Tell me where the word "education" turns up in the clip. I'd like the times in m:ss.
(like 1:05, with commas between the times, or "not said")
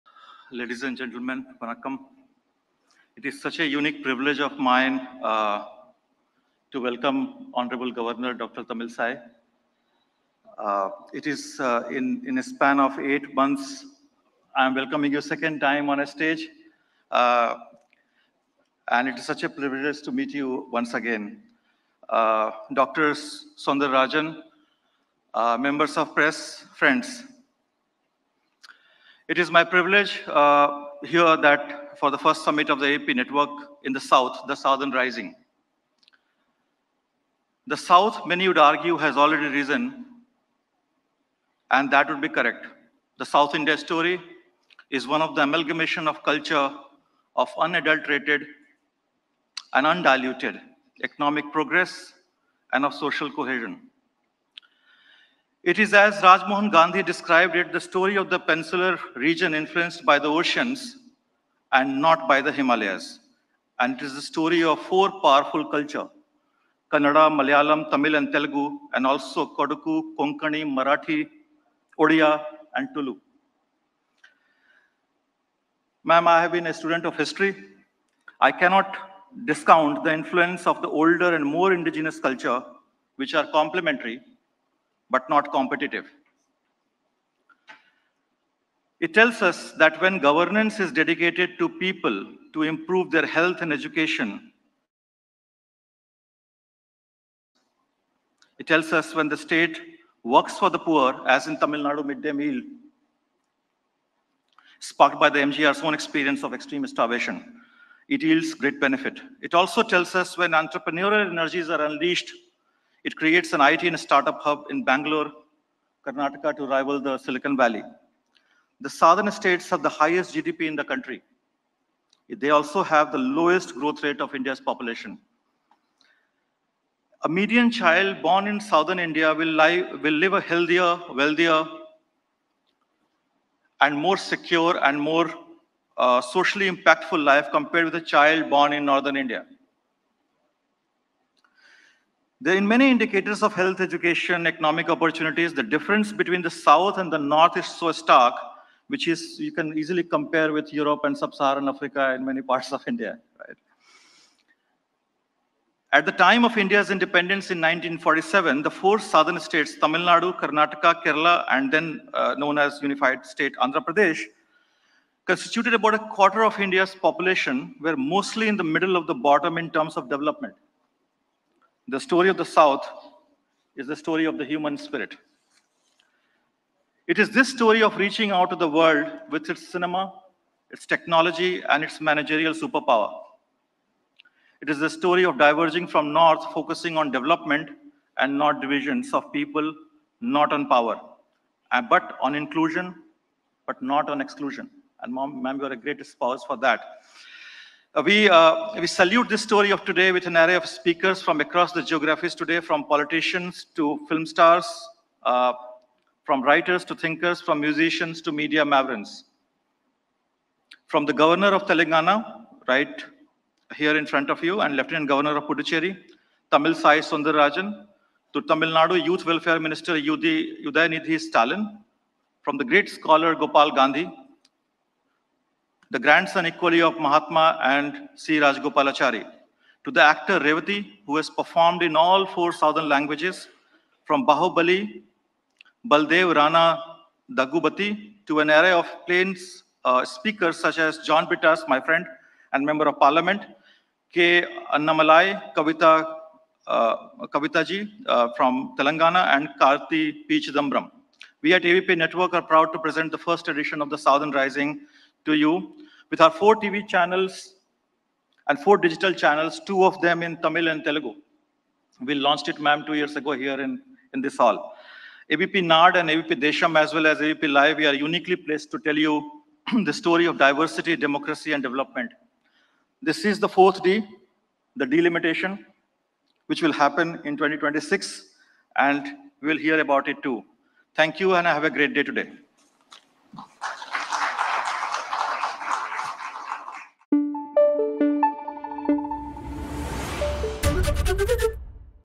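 1:33, 2:23.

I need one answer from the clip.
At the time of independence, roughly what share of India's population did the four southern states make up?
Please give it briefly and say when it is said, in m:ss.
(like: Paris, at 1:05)
a quarter, at 2:45.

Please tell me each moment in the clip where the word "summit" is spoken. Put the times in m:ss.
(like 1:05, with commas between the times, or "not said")
0:32.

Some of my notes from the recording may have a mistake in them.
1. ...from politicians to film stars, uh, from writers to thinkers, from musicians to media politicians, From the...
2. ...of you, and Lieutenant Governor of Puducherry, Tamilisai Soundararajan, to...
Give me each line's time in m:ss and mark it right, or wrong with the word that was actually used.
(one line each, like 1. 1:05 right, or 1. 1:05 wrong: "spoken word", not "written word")
1. 3:22 wrong: "mavens", not "politicians"
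2. 3:34 right.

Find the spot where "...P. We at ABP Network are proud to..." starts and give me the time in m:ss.
4:10.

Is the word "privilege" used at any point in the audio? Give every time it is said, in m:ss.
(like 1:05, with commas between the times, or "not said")
0:04, 0:19, 0:29.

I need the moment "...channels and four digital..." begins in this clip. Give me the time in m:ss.
4:16.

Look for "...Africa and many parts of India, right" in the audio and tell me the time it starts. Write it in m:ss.
2:31.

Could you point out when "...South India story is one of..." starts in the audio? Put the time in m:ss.
0:43.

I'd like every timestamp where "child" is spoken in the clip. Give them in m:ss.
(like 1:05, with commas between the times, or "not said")
2:07, 2:18.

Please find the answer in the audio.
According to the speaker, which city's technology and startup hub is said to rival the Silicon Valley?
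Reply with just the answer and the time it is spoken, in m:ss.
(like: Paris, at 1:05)
Bangalore, at 1:54.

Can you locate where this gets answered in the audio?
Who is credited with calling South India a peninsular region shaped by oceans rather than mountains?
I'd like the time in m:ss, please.
0:56.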